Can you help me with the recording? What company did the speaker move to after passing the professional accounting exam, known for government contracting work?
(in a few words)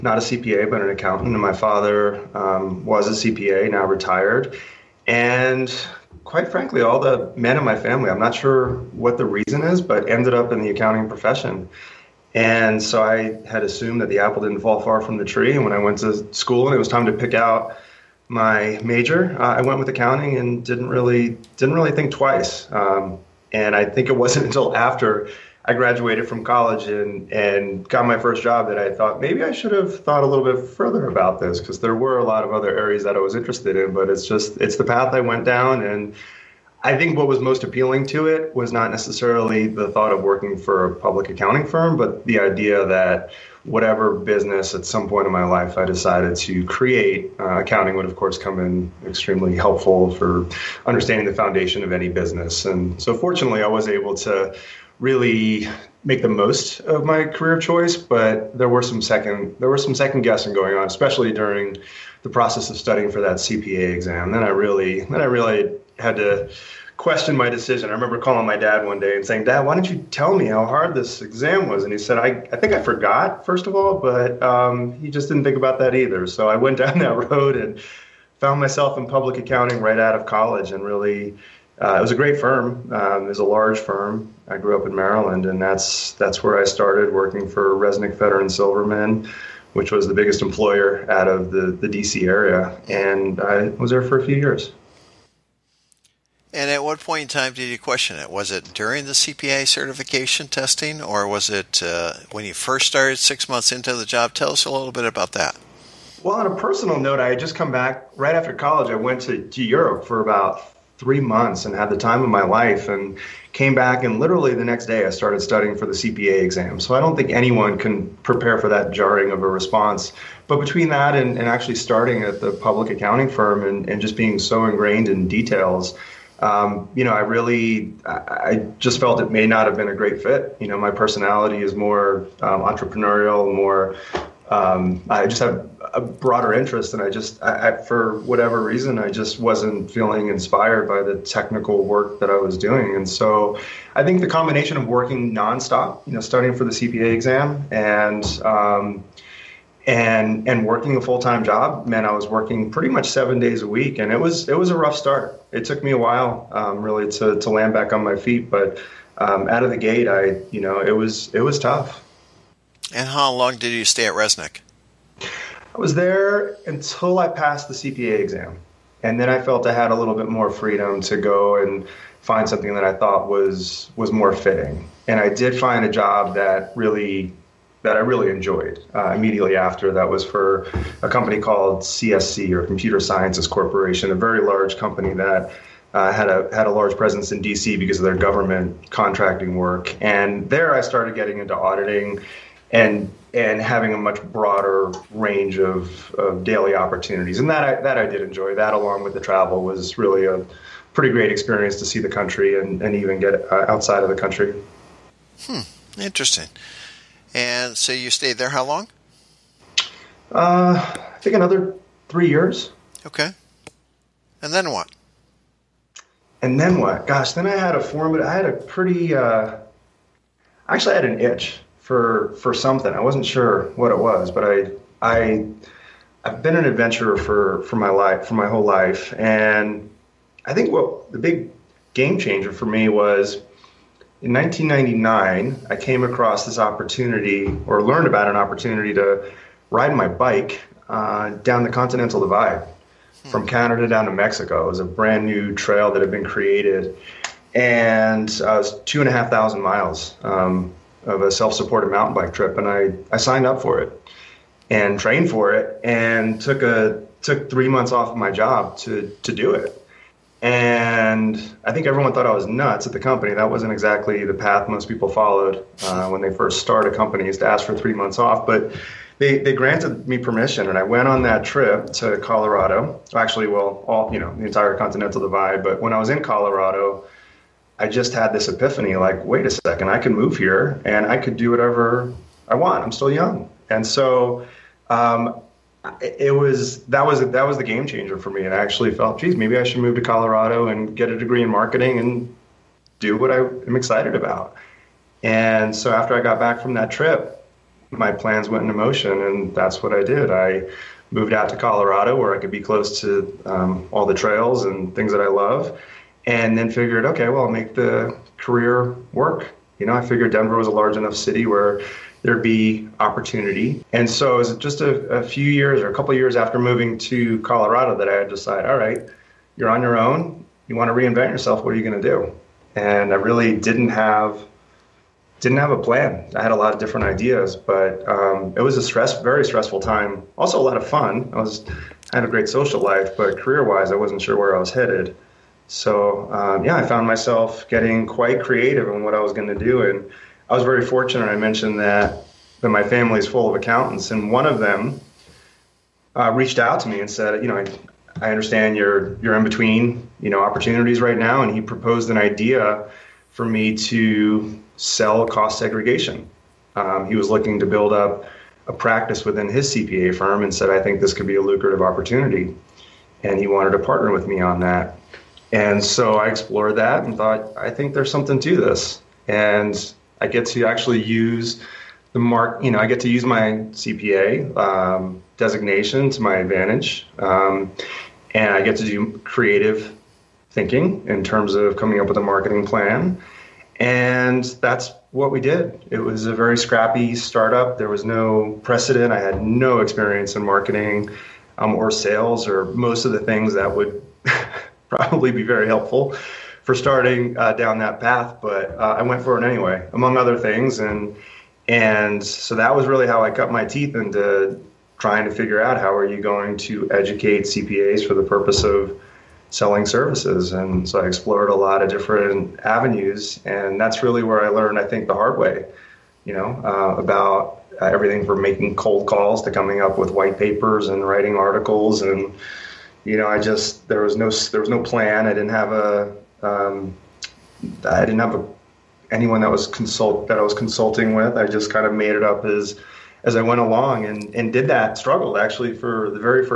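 Computer Sciences Corporation.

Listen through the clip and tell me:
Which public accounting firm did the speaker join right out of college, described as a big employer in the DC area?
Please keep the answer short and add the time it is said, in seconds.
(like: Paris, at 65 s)
Reznick and Silverman, at 87 s.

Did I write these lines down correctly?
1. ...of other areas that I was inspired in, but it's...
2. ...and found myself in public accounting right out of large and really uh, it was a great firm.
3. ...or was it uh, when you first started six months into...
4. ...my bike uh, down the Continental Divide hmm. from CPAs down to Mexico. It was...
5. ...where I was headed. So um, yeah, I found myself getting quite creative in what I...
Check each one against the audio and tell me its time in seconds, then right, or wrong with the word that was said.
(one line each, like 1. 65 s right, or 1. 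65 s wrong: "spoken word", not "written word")
1. 32 s wrong: "interested", not "inspired"
2. 77 s wrong: "college", not "large"
3. 101 s right
4. 239 s wrong: "Canada", not "CPAs"
5. 334 s right.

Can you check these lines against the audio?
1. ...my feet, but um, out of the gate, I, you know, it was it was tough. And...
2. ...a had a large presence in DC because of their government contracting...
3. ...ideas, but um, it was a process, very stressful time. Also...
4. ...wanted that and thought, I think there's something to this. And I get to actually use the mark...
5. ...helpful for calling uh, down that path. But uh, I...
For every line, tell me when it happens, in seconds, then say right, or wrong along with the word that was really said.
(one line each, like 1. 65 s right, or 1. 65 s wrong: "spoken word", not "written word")
1. 158 s right
2. 186 s right
3. 327 s wrong: "stress", not "process"
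4. 366 s wrong: "explored", not "wanted"
5. 395 s wrong: "starting", not "calling".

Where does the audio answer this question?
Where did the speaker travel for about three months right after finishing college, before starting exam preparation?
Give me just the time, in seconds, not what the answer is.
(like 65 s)
109 s.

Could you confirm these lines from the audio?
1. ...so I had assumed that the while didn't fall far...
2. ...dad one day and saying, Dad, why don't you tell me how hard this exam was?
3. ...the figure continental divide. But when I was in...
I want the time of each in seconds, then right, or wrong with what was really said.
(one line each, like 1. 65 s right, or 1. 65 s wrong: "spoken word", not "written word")
1. 12 s wrong: "apple", not "while"
2. 68 s right
3. 274 s wrong: "entire", not "figure".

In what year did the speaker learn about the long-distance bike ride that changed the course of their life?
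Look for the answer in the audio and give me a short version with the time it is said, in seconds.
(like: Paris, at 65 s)
1999, at 234 s.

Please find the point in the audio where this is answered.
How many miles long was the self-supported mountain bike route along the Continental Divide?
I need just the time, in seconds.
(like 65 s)
248 s.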